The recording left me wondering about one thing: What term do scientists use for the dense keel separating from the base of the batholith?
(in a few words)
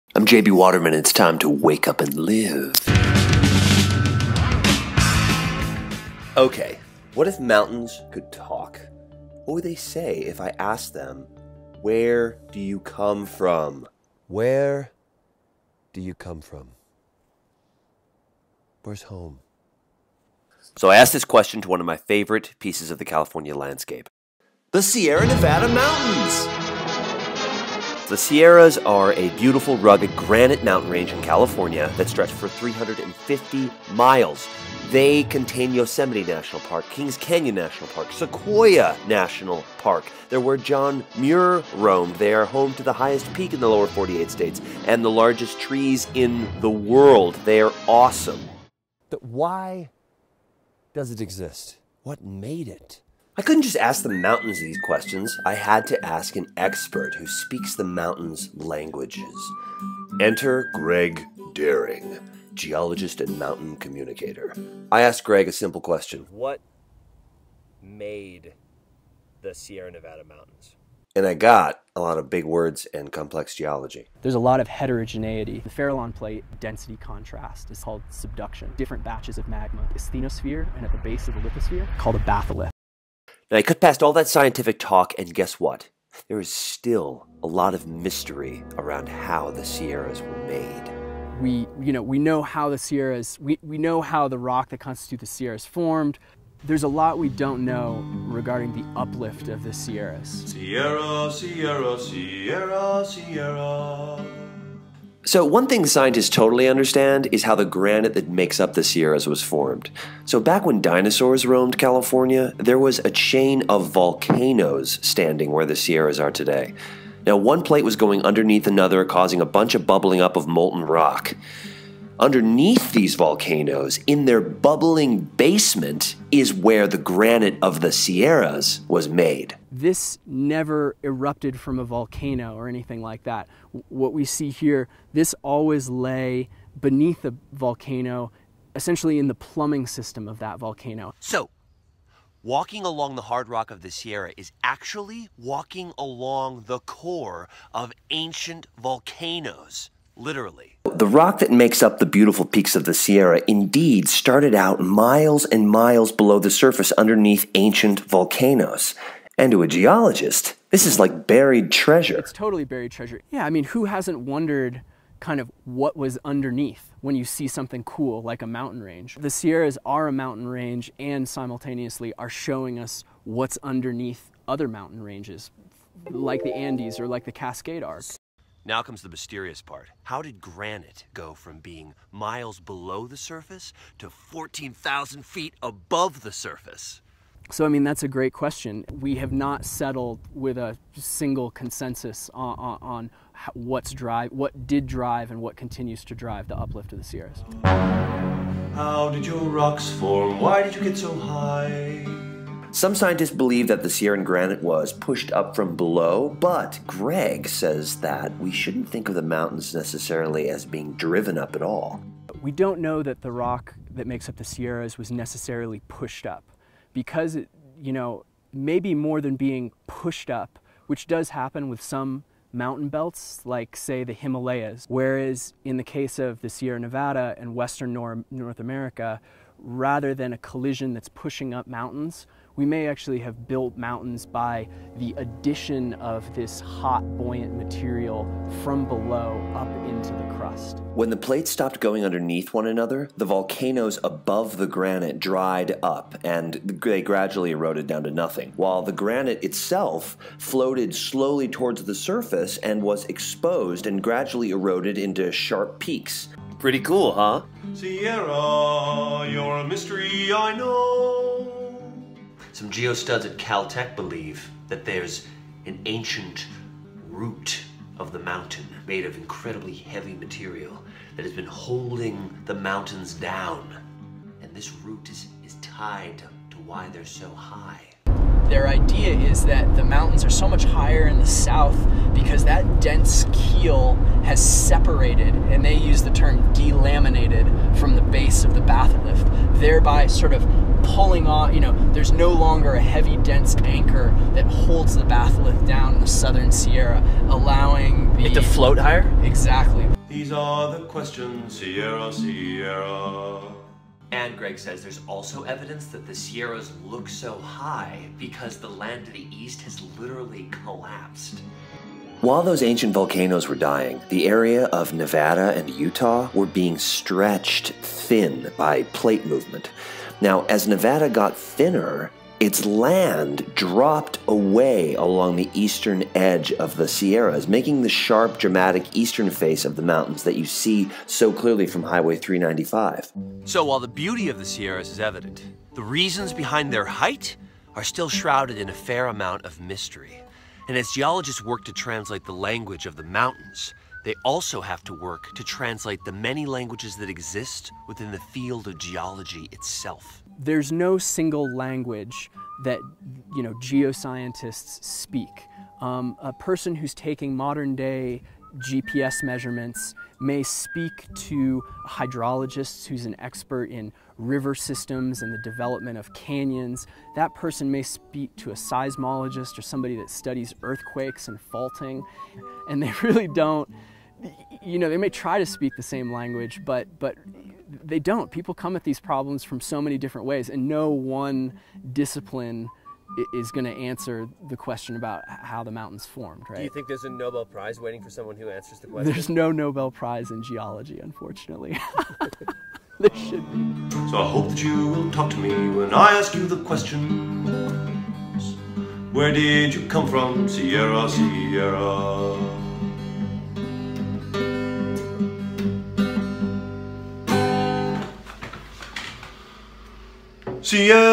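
delaminated.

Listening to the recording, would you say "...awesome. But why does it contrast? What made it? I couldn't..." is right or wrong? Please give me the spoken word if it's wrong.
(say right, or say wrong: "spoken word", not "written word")
wrong: "exist", not "contrast".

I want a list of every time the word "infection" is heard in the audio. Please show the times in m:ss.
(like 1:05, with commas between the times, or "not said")
not said.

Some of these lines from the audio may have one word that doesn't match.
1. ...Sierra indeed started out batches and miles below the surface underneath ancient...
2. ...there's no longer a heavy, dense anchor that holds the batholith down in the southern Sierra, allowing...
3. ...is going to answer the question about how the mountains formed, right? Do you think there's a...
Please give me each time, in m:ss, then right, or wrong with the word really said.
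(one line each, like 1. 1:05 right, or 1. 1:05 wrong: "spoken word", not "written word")
1. 2:32 wrong: "miles", not "batches"
2. 4:51 right
3. 6:23 right.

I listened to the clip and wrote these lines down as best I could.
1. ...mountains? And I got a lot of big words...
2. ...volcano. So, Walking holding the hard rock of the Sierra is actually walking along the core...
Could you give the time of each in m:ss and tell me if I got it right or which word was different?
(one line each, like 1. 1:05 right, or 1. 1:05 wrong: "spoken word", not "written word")
1. 1:10 right
2. 2:20 wrong: "along", not "holding".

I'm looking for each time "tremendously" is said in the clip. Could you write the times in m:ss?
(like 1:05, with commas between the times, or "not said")
not said.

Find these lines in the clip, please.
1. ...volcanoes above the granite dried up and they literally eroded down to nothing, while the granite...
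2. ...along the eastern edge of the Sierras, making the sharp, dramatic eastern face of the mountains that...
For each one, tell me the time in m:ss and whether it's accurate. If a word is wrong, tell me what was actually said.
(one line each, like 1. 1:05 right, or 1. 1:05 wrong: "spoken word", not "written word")
1. 4:03 wrong: "gradually", not "literally"
2. 5:24 right.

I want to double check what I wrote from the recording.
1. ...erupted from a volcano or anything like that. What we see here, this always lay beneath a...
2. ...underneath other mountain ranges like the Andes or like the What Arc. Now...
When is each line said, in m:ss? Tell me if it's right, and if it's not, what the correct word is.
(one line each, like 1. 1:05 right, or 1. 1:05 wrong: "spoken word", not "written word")
1. 2:11 right
2. 2:53 wrong: "Cascade", not "What".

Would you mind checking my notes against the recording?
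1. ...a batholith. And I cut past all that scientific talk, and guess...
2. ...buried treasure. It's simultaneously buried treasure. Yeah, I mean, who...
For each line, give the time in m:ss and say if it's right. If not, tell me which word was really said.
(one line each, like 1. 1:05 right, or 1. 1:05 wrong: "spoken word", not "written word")
1. 1:22 right
2. 2:41 wrong: "totally", not "simultaneously".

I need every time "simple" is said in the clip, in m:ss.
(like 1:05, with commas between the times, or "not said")
1:05.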